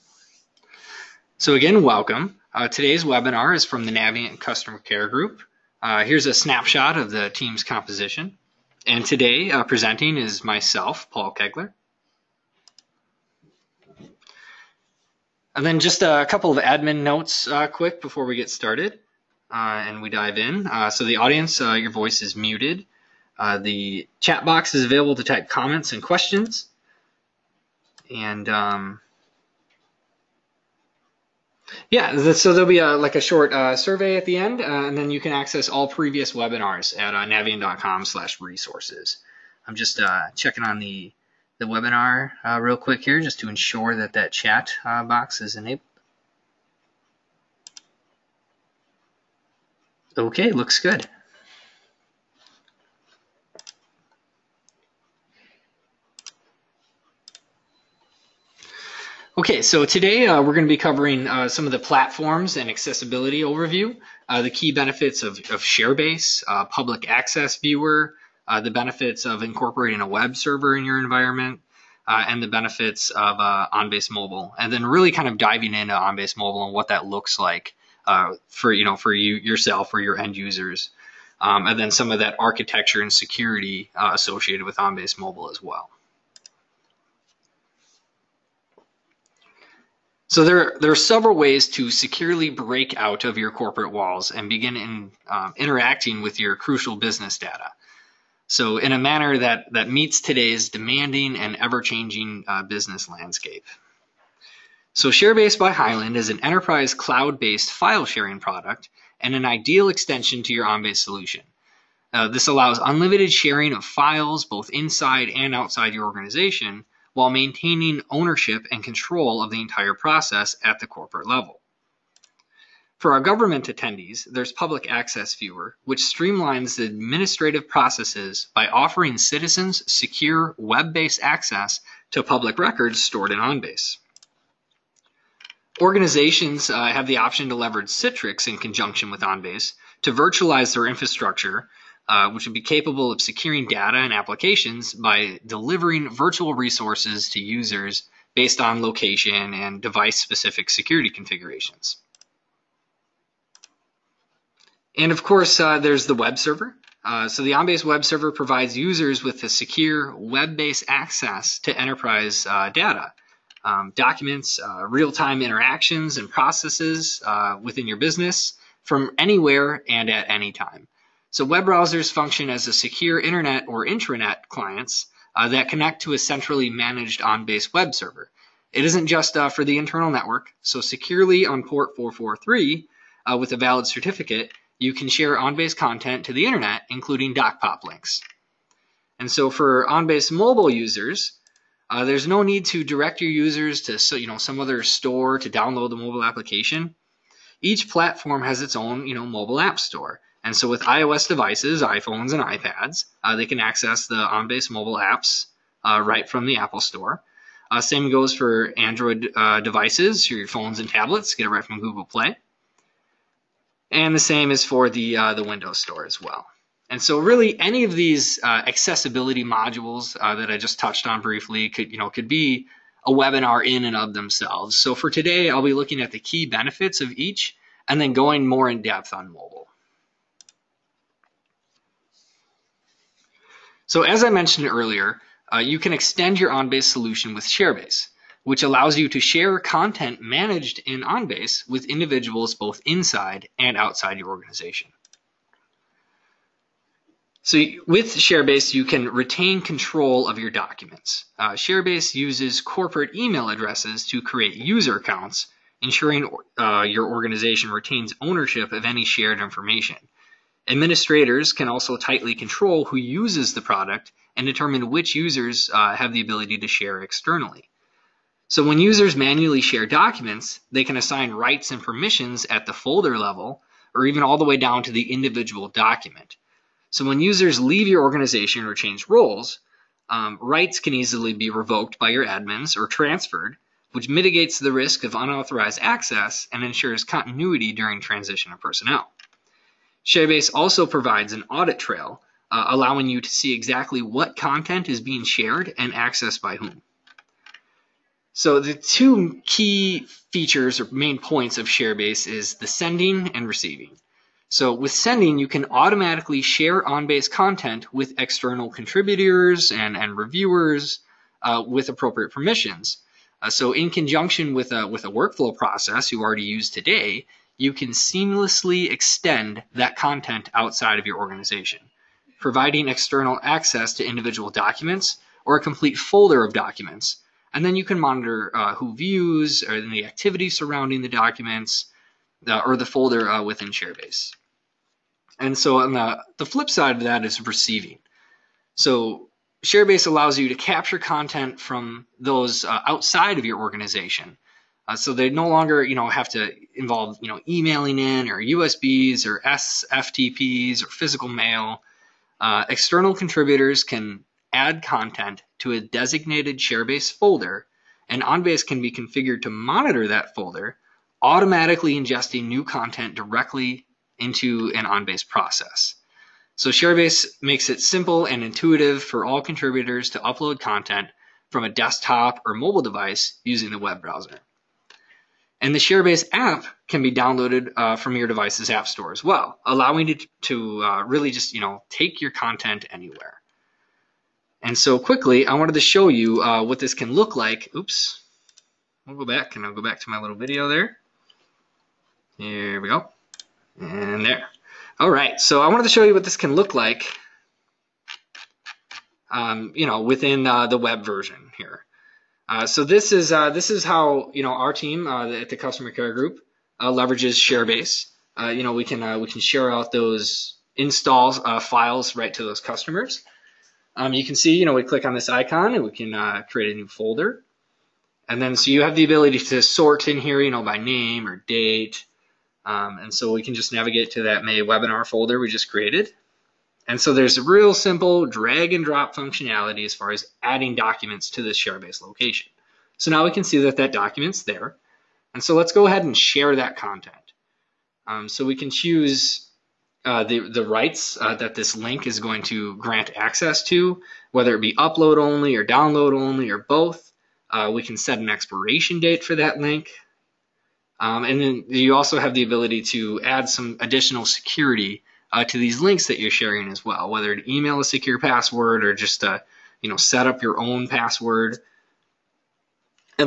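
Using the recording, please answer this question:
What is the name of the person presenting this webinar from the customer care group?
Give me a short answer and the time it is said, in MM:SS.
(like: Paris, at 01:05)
Paul Kegler, at 00:11.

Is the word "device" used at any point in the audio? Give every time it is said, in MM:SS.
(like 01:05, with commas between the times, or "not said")
02:29, 03:21, 03:29, 06:12, 06:18.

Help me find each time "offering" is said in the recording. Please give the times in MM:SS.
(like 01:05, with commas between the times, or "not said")
02:08.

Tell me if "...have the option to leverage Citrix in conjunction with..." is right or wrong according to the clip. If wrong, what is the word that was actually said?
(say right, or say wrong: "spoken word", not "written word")
right.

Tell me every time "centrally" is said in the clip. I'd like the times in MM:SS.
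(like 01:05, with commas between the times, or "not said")
02:56.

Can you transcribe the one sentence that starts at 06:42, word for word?
Uh, so this is uh, this is how you know our team uh, at the customer care group uh, leverages Sharebase.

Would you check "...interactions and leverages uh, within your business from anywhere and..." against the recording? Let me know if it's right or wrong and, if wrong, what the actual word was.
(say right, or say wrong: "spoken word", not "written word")
wrong: "processes", not "leverages".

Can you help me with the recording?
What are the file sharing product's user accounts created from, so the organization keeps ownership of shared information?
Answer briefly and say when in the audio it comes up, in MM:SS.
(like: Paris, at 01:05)
corporate email addresses, at 04:12.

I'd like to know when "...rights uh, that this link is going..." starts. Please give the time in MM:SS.
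07:20.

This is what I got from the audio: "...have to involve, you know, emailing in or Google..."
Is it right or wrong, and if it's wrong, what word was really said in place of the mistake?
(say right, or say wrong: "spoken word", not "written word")
wrong: "USBs", not "Google".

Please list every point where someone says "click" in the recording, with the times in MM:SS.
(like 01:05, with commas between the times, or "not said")
06:54.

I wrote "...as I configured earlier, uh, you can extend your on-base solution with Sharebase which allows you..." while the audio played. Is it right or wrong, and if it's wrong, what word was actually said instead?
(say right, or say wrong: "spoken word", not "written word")
wrong: "mentioned", not "configured".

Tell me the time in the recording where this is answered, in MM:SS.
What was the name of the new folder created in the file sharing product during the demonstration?
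07:04.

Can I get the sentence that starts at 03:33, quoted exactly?
And the same is for the, uh, the Windows Store as well.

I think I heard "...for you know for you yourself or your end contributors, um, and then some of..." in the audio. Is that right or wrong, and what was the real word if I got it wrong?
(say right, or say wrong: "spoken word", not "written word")
wrong: "users", not "contributors".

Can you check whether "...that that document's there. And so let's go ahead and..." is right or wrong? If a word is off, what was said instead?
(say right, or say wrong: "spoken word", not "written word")
right.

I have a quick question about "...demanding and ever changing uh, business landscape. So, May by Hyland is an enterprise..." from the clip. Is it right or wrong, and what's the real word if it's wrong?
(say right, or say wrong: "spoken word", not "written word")
wrong: "Sharebase", not "May".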